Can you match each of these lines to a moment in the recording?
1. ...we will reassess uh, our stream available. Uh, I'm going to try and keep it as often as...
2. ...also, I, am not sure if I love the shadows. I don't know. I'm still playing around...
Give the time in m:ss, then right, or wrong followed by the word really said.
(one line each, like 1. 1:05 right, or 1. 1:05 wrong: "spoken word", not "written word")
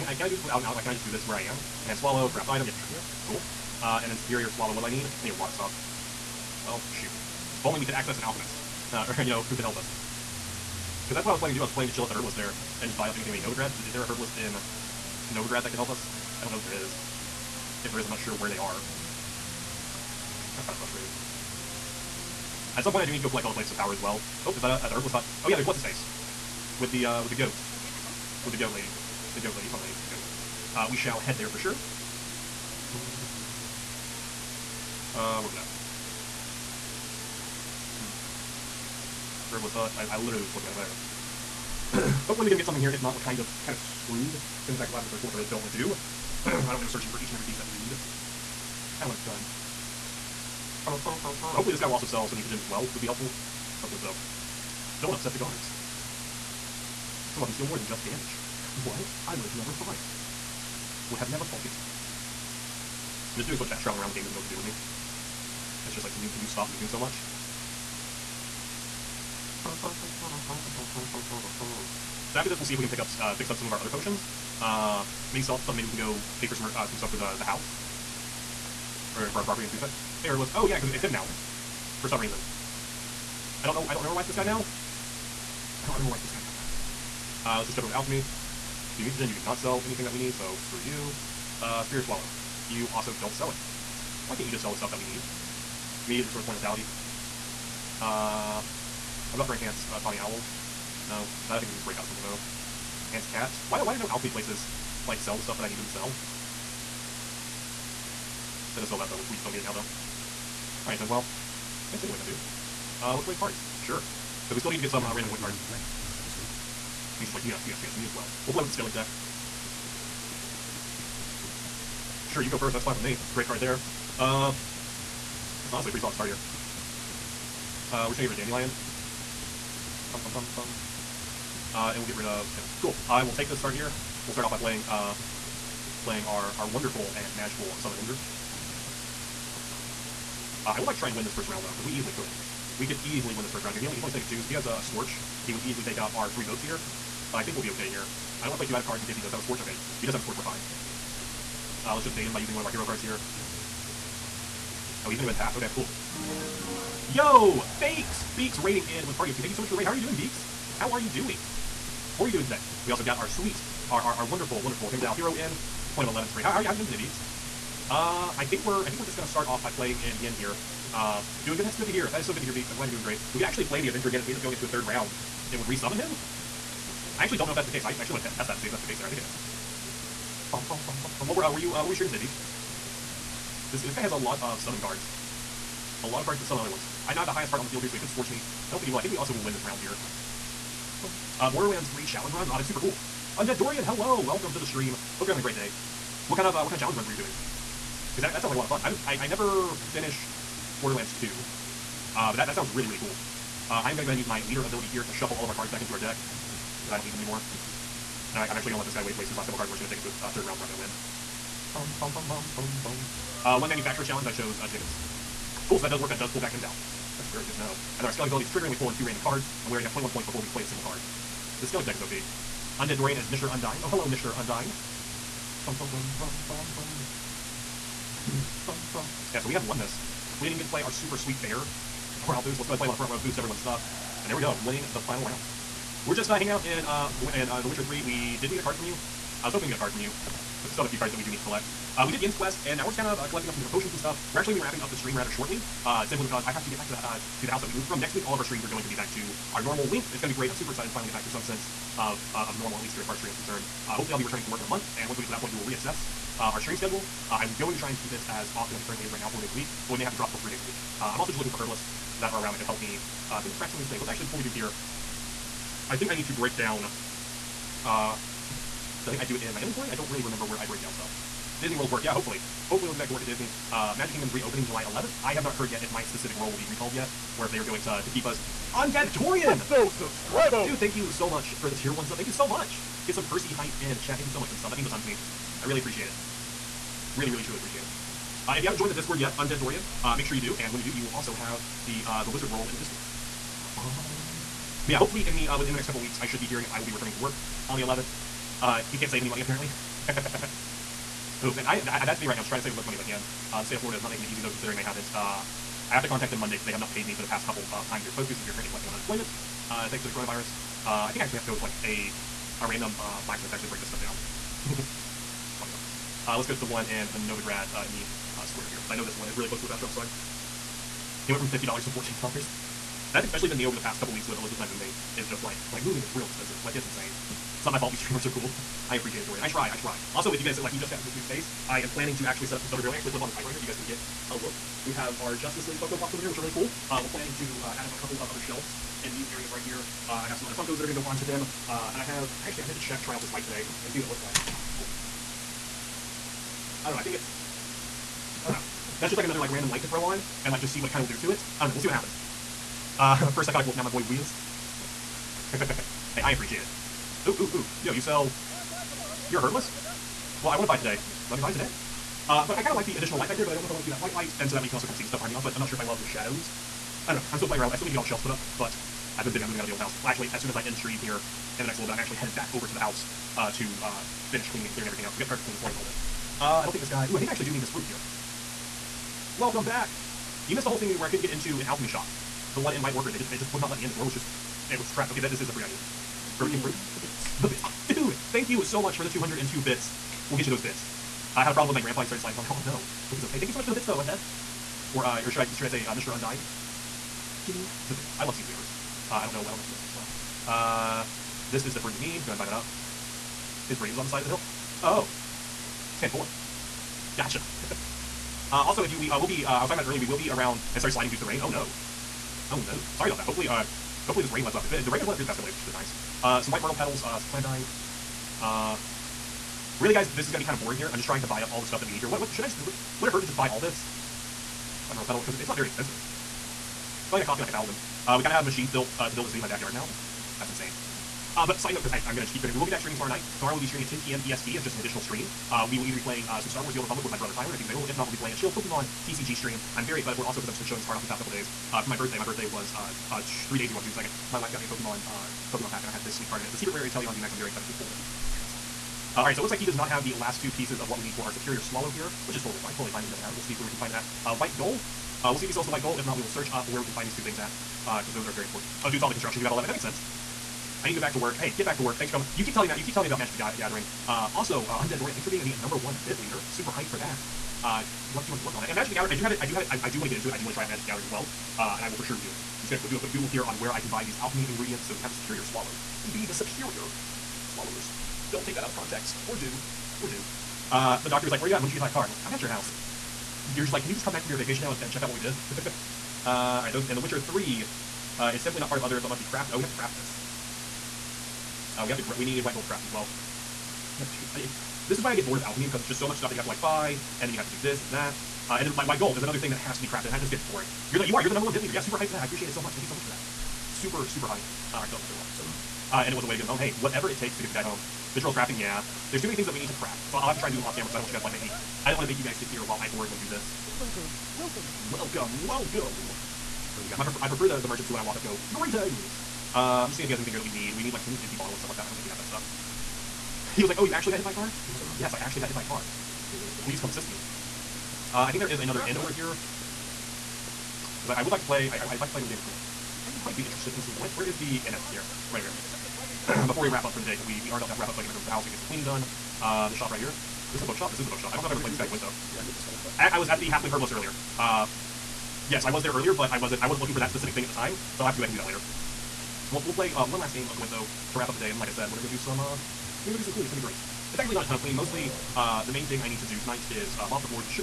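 1. 4:15 wrong: "schedule", not "available"
2. 6:05 right.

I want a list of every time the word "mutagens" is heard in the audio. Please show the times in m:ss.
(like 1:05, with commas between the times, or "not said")
0:52, 1:29.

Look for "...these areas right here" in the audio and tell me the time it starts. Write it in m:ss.
5:39.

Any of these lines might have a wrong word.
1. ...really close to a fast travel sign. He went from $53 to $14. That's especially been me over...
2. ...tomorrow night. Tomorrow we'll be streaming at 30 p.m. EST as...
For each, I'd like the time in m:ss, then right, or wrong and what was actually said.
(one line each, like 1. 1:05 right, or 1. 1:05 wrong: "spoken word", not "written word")
1. 5:19 wrong: "50", not "53"
2. 7:12 wrong: "10", not "30".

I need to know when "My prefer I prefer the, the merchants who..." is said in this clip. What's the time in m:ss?
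8:36.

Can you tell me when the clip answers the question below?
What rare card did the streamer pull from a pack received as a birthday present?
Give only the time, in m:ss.
7:26.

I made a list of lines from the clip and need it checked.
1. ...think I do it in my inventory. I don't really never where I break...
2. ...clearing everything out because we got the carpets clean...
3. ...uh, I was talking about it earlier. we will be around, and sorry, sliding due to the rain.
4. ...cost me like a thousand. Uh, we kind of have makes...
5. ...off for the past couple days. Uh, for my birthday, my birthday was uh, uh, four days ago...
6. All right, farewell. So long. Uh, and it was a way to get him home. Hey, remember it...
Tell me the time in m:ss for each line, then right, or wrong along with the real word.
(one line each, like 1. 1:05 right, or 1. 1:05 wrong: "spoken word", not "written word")
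1. 4:29 wrong: "remember", not "never"
2. 6:14 right
3. 6:49 right
4. 7:07 wrong: "machines", not "makes"
5. 7:20 wrong: "three", not "four"
6. 8:24 wrong: "whatever", not "remember".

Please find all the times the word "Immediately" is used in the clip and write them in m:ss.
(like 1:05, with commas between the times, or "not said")
1:36.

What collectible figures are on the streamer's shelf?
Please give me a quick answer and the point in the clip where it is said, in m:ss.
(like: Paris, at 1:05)
Justice League Funko Pops, at 5:35.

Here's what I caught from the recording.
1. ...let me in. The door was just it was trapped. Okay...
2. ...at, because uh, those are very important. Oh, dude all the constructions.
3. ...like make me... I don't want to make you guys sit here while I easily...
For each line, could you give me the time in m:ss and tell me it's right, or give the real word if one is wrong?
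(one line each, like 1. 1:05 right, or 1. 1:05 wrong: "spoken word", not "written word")
1. 6:23 right
2. 7:37 right
3. 8:31 wrong: "boringly", not "easily".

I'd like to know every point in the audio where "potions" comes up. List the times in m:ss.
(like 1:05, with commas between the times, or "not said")
1:13, 4:03.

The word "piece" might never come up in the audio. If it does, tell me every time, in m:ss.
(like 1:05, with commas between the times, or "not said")
0:47, 7:30.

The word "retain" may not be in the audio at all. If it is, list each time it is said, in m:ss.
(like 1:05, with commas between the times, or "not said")
not said.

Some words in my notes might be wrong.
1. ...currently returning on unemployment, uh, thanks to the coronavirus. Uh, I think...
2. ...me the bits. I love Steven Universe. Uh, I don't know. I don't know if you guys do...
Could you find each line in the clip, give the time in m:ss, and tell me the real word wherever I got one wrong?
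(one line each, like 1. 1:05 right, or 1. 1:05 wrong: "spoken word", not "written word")
1. 5:08 wrong: "collecting", not "returning"
2. 6:37 right.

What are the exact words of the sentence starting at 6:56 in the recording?
Uh, some white myrtle petals, uh, some celandine.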